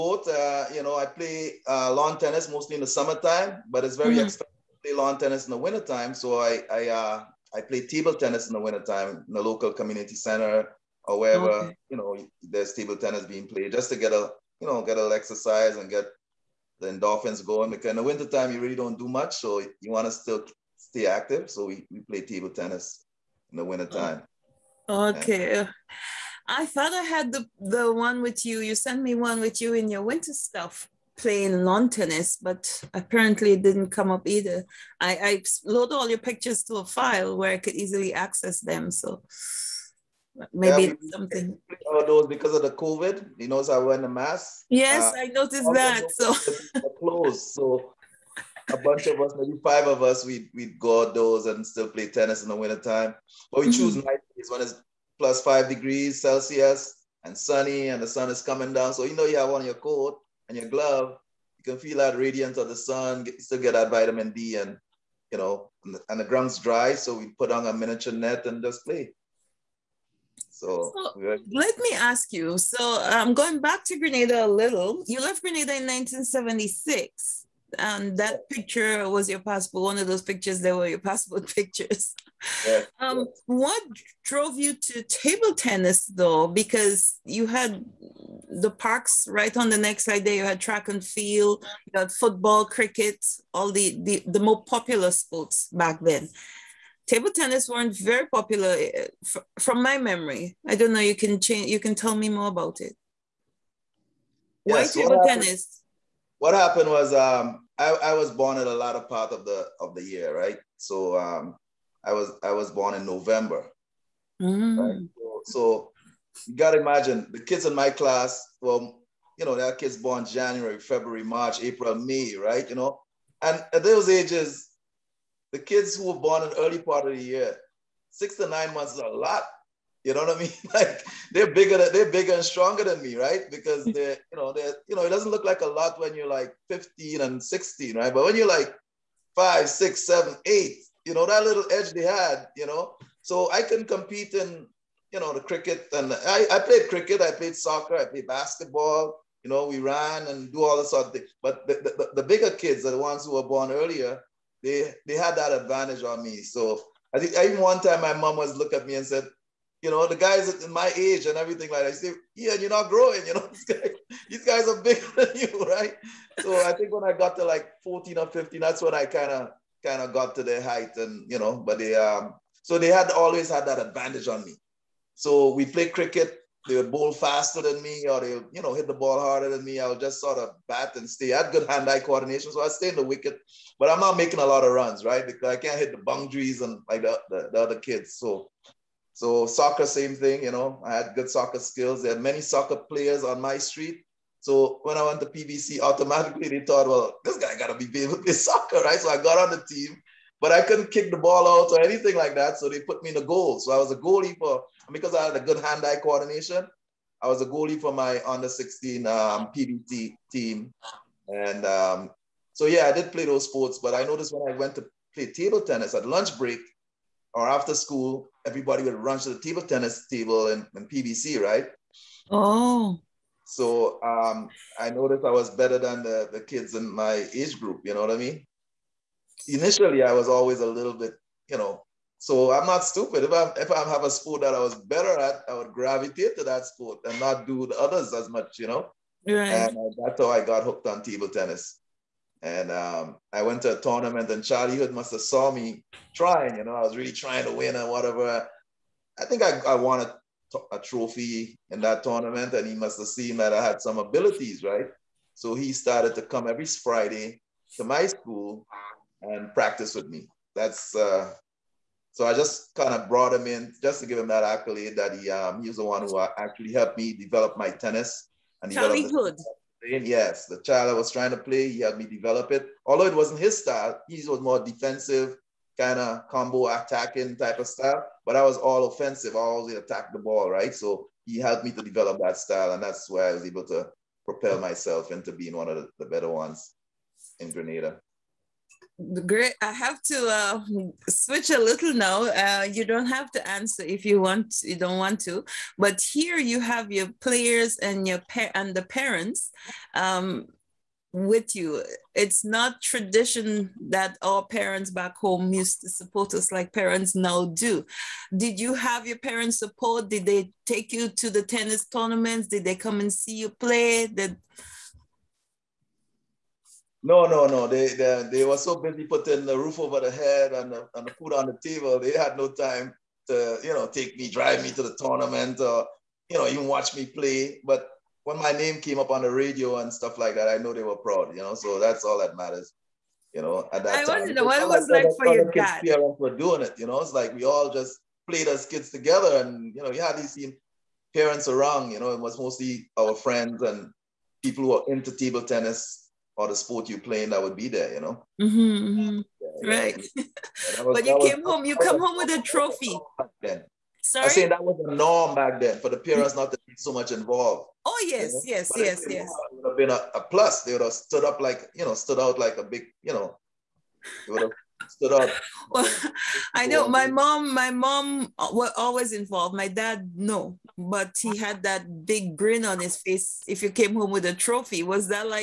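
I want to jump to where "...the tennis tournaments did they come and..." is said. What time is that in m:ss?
5:11.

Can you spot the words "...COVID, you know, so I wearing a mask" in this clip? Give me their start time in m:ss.
0:42.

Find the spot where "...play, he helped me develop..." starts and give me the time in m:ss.
4:31.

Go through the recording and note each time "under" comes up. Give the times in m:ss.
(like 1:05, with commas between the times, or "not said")
3:28.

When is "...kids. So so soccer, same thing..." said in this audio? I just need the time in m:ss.
3:07.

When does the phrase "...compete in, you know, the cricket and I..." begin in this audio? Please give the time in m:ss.
2:23.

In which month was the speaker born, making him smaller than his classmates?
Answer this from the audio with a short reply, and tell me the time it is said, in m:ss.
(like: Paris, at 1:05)
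November, at 1:53.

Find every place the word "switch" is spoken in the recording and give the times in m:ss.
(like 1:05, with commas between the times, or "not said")
4:51.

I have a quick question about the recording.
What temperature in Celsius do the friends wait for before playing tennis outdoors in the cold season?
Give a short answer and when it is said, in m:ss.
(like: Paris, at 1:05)
5 degrees, at 0:55.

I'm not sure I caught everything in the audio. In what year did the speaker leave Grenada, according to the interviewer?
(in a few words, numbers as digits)
1976.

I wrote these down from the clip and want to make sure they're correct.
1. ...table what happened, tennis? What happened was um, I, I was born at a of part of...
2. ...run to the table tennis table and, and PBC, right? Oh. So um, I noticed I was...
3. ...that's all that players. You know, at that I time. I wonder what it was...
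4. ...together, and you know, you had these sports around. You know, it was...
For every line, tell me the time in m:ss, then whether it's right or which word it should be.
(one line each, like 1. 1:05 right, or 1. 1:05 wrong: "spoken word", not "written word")
1. 1:45 right
2. 3:38 right
3. 5:31 wrong: "matters", not "players"
4. 5:38 wrong: "parents", not "sports".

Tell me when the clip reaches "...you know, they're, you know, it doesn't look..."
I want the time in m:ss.
2:14.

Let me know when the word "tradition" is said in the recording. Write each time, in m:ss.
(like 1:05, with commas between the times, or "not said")
5:02.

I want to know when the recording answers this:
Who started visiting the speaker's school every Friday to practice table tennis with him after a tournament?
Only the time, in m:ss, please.
4:04.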